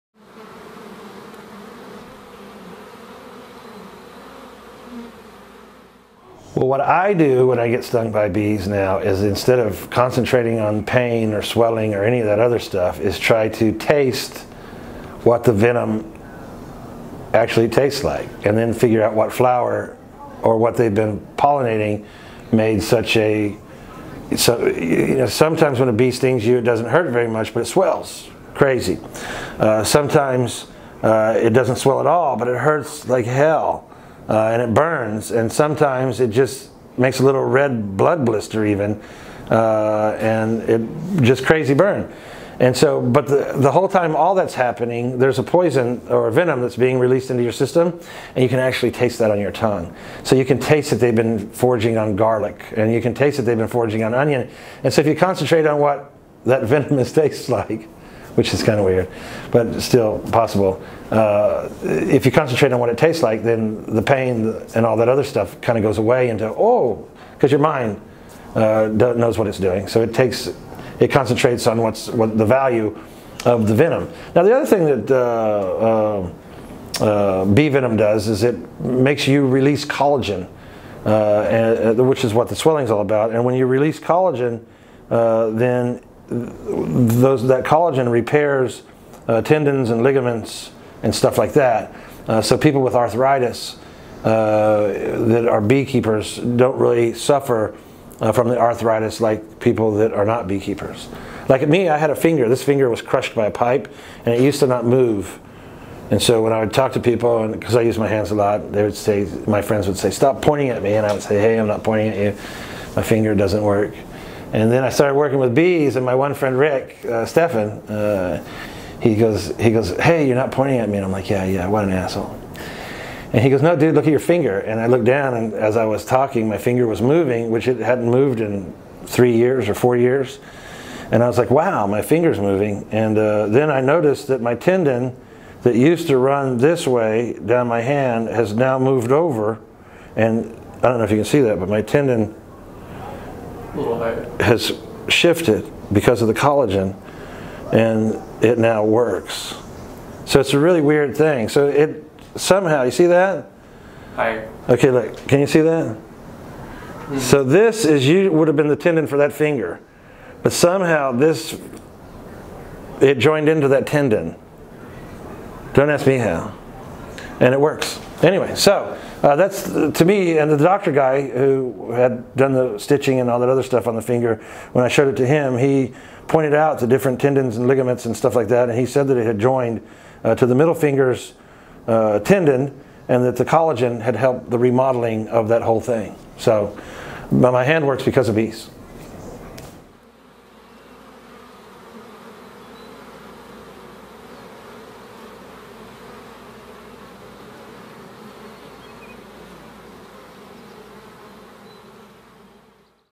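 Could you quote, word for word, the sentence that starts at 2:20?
And I don't know if you can see that, but my tendon has shifted because of the collagen and it now works.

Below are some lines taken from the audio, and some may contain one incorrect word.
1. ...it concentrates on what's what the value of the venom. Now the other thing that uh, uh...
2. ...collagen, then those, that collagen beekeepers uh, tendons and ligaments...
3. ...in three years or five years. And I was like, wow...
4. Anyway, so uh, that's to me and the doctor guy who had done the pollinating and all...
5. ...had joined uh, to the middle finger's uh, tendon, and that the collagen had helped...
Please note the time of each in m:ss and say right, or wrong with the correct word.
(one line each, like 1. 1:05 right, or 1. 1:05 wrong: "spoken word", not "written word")
1. 1:10 right
2. 1:23 wrong: "repairs", not "beekeepers"
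3. 2:08 wrong: "four", not "five"
4. 2:48 wrong: "stitching", not "pollinating"
5. 2:59 right.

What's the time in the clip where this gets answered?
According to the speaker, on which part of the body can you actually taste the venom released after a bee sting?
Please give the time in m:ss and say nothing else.
0:49.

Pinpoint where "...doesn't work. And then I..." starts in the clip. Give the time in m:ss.
1:53.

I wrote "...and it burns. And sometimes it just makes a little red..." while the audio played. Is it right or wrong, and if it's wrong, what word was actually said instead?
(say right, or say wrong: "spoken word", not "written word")
right.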